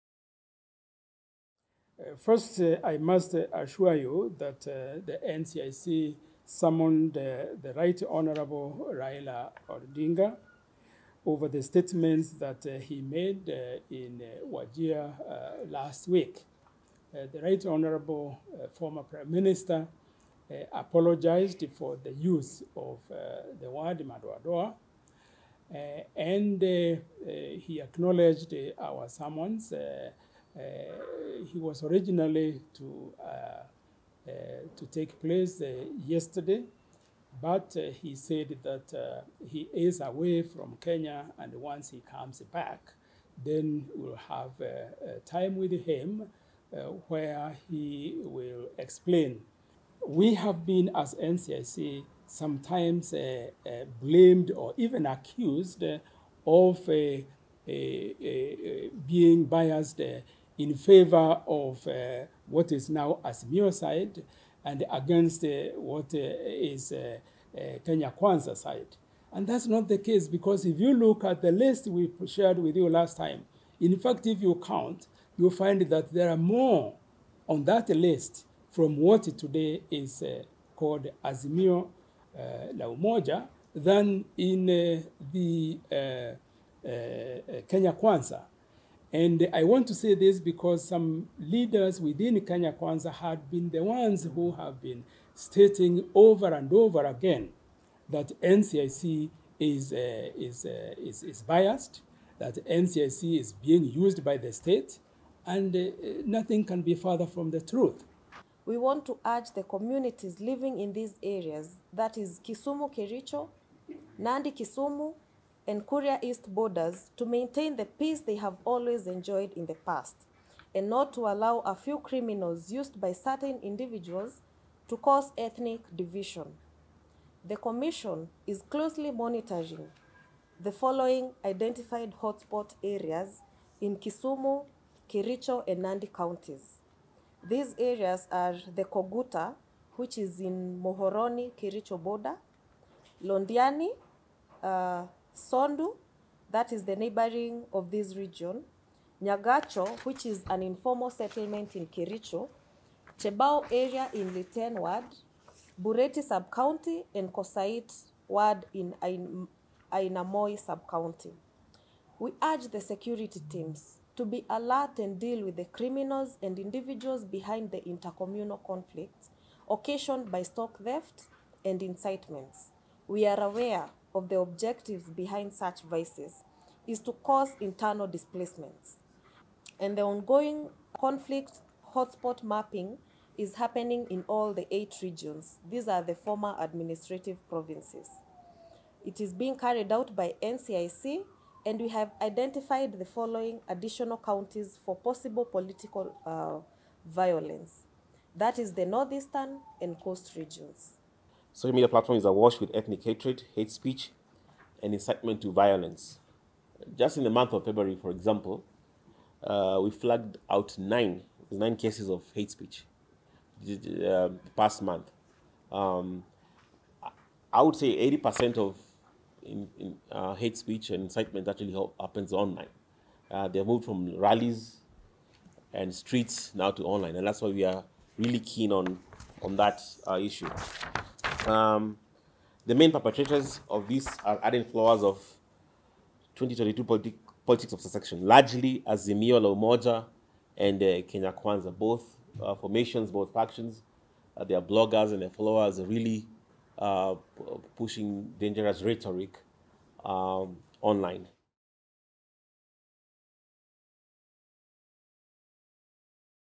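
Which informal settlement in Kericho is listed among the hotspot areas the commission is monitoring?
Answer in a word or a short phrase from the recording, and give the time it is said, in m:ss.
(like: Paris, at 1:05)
Nyagacho, at 2:29.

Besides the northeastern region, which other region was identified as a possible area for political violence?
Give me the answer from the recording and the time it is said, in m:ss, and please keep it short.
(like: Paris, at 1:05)
Coast, at 3:19.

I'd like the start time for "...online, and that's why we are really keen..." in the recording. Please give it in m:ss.
3:46.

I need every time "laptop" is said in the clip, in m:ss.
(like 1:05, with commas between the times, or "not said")
not said.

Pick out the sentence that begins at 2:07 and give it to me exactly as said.
The Commission is closely monitoring the following identified hotspot areas in Kisumu, Kericho, and Nandi counties.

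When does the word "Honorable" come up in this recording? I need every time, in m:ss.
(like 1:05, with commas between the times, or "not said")
0:08, 0:17.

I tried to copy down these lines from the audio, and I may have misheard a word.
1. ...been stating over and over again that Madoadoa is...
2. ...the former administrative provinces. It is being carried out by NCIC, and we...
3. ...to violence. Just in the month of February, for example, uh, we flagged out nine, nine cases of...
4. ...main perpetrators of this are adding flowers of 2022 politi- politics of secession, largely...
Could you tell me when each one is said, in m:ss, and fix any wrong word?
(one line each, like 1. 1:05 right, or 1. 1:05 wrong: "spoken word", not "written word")
1. 1:34 wrong: "NCIC", not "Madoadoa"
2. 3:06 right
3. 3:25 right
4. 3:52 right.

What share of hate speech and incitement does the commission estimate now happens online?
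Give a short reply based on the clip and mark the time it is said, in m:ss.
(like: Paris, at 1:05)
80%, at 3:38.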